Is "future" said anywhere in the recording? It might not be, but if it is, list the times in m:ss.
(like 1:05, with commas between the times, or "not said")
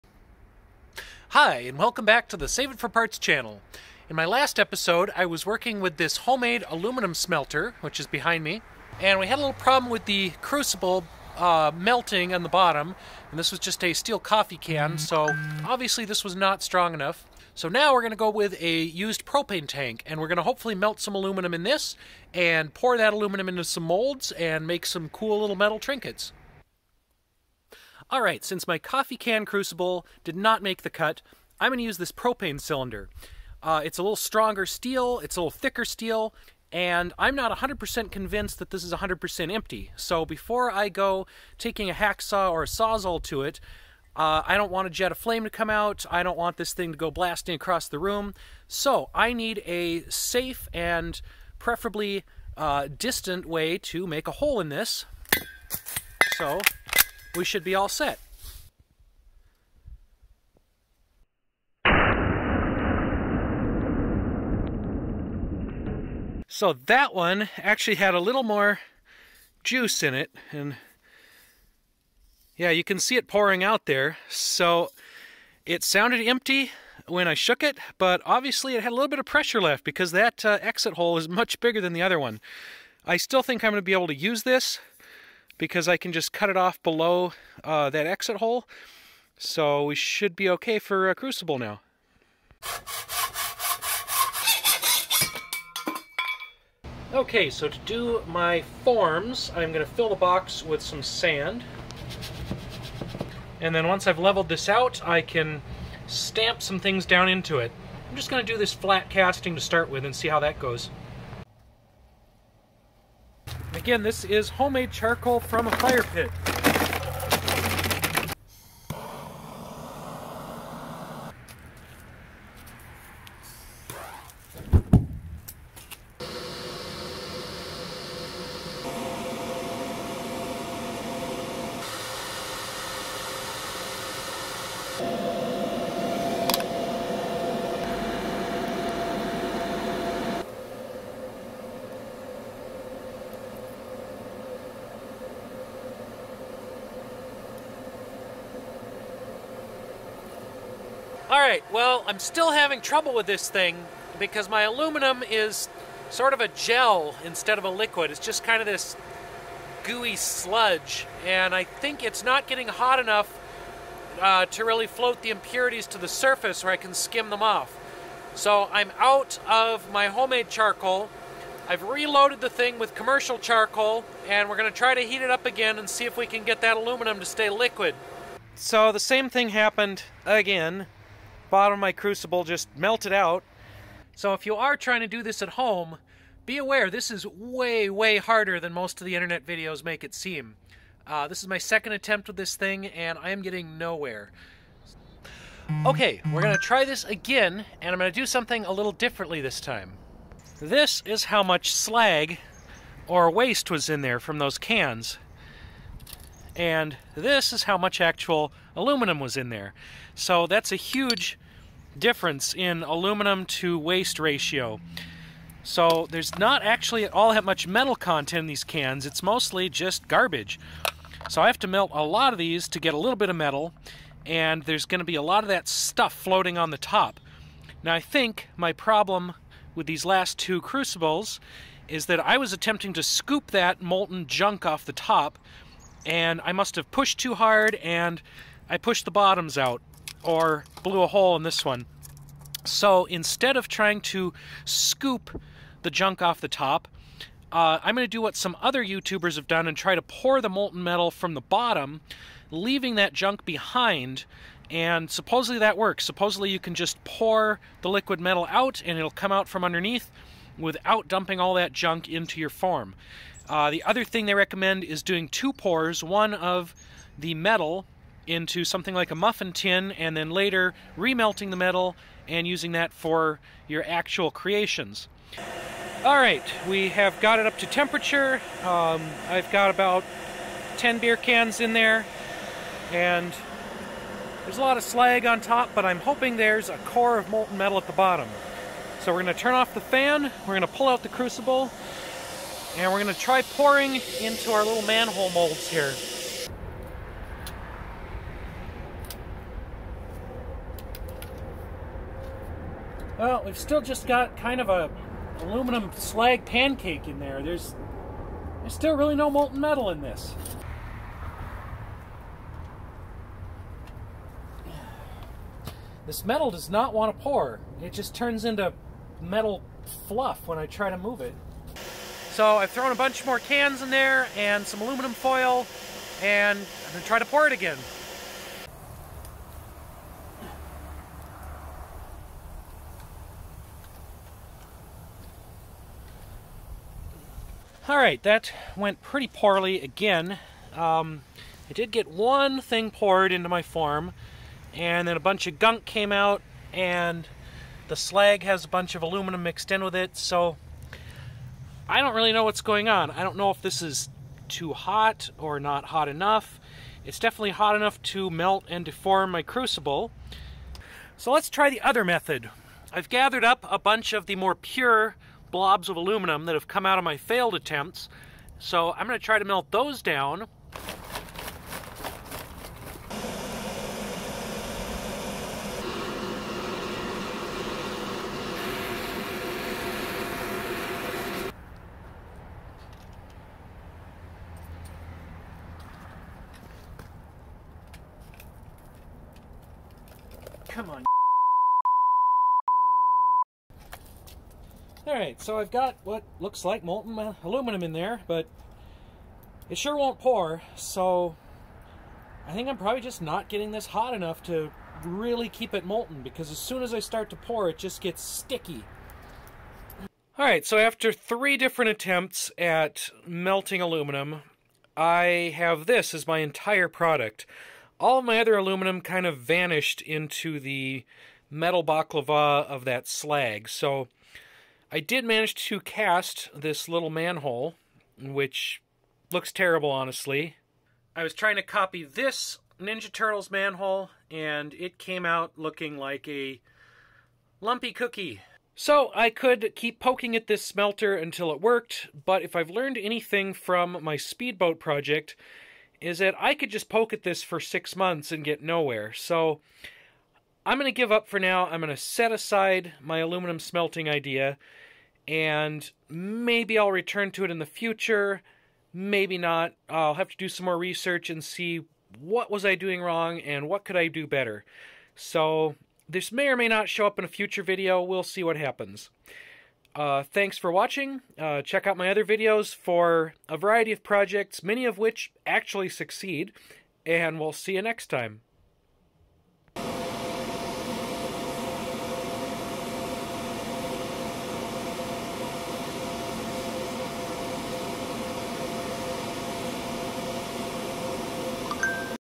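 7:37, 7:47.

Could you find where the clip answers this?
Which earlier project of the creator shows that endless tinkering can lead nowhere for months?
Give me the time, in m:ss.
7:24.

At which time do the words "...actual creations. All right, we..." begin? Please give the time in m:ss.
4:33.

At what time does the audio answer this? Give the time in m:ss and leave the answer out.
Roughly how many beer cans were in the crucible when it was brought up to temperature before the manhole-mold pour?
4:40.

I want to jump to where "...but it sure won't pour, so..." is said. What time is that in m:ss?
6:38.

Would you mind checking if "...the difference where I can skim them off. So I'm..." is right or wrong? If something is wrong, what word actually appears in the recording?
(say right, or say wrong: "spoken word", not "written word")
wrong: "surface", not "difference".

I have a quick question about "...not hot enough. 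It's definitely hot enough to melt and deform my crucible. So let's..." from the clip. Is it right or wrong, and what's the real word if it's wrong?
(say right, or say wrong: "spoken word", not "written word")
right.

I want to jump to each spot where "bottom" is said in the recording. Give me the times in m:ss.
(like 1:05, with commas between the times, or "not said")
0:12, 3:01, 3:59, 4:11, 4:47.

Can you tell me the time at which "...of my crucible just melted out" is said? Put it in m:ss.
3:01.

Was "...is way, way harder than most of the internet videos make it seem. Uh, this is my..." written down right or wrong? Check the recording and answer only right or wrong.
right.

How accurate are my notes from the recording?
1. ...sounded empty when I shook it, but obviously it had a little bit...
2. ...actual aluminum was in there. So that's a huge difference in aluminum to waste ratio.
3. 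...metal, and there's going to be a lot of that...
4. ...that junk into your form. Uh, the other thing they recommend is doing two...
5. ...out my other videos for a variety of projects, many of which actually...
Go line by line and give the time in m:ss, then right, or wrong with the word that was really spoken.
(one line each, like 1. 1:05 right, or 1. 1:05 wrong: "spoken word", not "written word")
1. 1:15 right
2. 3:28 right
3. 3:43 right
4. 4:21 right
5. 7:51 right.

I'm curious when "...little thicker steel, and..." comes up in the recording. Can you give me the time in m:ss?
0:35.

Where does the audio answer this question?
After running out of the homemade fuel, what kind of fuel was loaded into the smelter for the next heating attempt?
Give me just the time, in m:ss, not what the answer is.
2:52.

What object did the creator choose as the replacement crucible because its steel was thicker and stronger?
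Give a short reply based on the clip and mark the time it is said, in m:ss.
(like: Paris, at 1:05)
propane tank, at 0:19.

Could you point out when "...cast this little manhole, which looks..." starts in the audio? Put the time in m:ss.
7:05.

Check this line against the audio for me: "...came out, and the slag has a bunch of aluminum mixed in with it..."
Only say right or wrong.
right.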